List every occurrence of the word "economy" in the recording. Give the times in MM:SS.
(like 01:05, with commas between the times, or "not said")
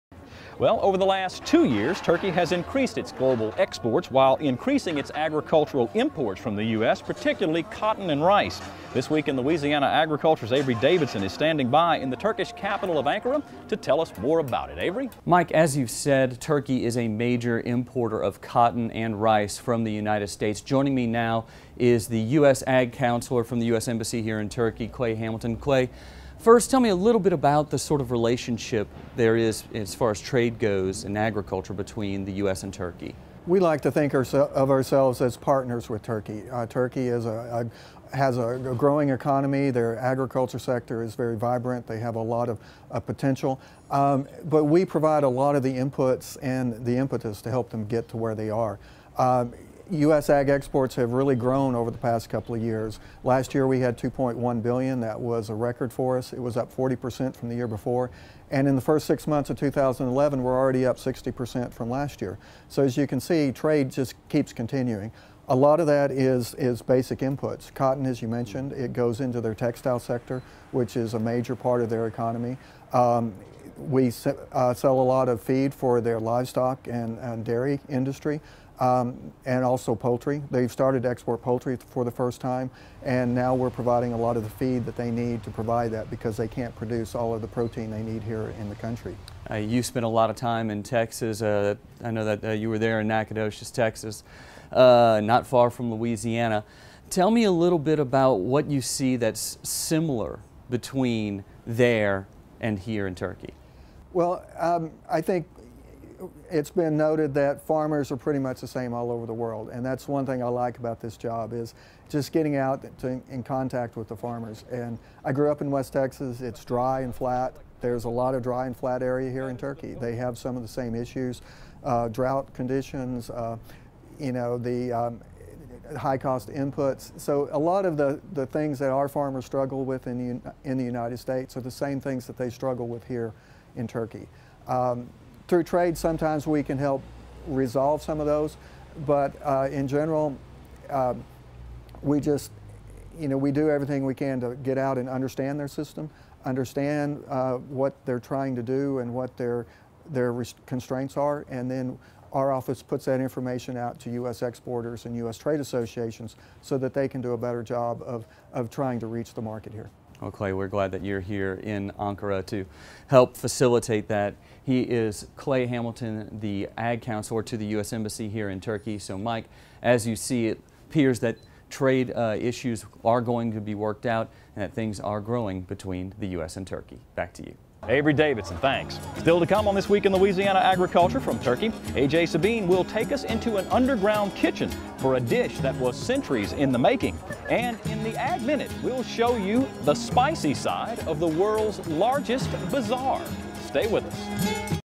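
00:39, 01:12.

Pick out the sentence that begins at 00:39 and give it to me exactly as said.
Their agriculture sector is very vibrant.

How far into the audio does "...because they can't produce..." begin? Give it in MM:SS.
01:26.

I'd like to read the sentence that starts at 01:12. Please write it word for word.
Um, we uh, sell a lot of feed for their livestock and, and dairy industry um, and also poultry.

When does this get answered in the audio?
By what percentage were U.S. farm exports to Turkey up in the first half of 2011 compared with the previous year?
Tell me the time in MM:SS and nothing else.
01:00.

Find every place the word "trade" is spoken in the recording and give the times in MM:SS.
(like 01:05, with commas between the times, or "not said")
00:30, 01:03, 02:15, 02:35, 02:51.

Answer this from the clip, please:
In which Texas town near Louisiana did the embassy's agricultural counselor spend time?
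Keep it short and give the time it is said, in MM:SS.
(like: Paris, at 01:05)
Nacogdoches, at 01:33.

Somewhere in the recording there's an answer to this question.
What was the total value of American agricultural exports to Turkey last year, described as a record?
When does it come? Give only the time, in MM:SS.
00:53.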